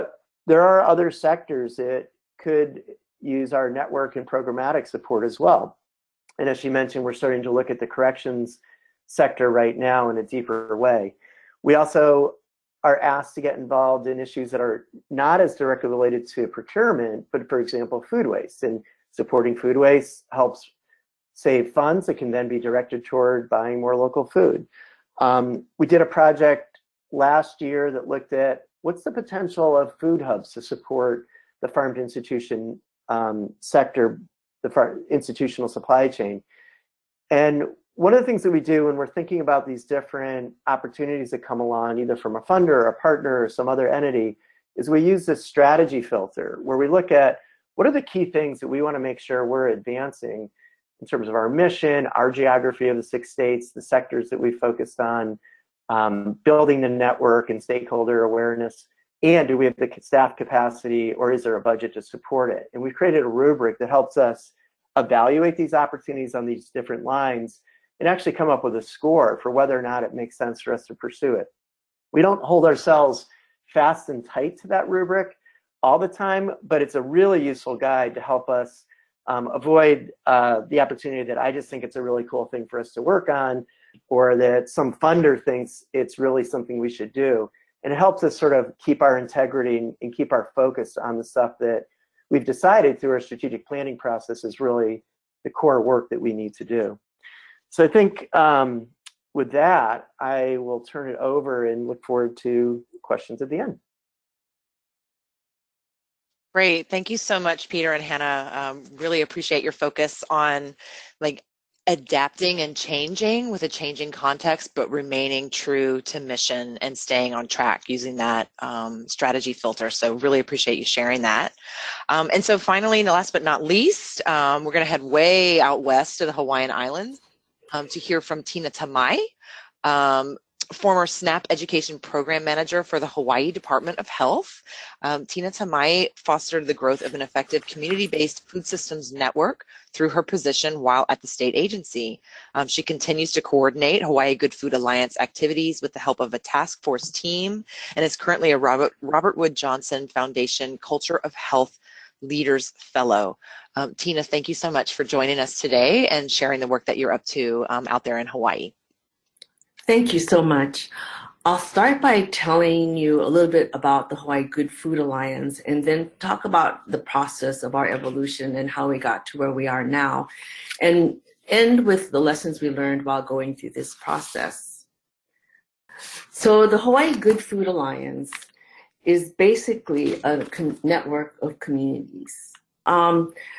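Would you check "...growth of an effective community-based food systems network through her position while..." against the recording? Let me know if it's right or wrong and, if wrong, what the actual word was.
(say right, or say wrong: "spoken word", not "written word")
right.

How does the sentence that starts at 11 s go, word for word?
We also are asked to get involved in issues that are not as directly related to procurement, but for example, food waste.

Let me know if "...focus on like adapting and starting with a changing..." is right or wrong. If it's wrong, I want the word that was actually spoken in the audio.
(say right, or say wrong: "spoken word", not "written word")
wrong: "changing", not "starting".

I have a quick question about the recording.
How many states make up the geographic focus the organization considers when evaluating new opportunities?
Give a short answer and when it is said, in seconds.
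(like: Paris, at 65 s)
6, at 53 s.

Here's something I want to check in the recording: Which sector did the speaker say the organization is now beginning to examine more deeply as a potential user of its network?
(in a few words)
corrections.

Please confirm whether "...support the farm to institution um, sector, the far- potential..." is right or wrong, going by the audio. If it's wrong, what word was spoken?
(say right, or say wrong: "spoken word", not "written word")
wrong: "institutional", not "potential".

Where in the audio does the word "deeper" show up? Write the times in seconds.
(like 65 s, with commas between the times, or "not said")
10 s.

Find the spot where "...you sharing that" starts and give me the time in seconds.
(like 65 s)
120 s.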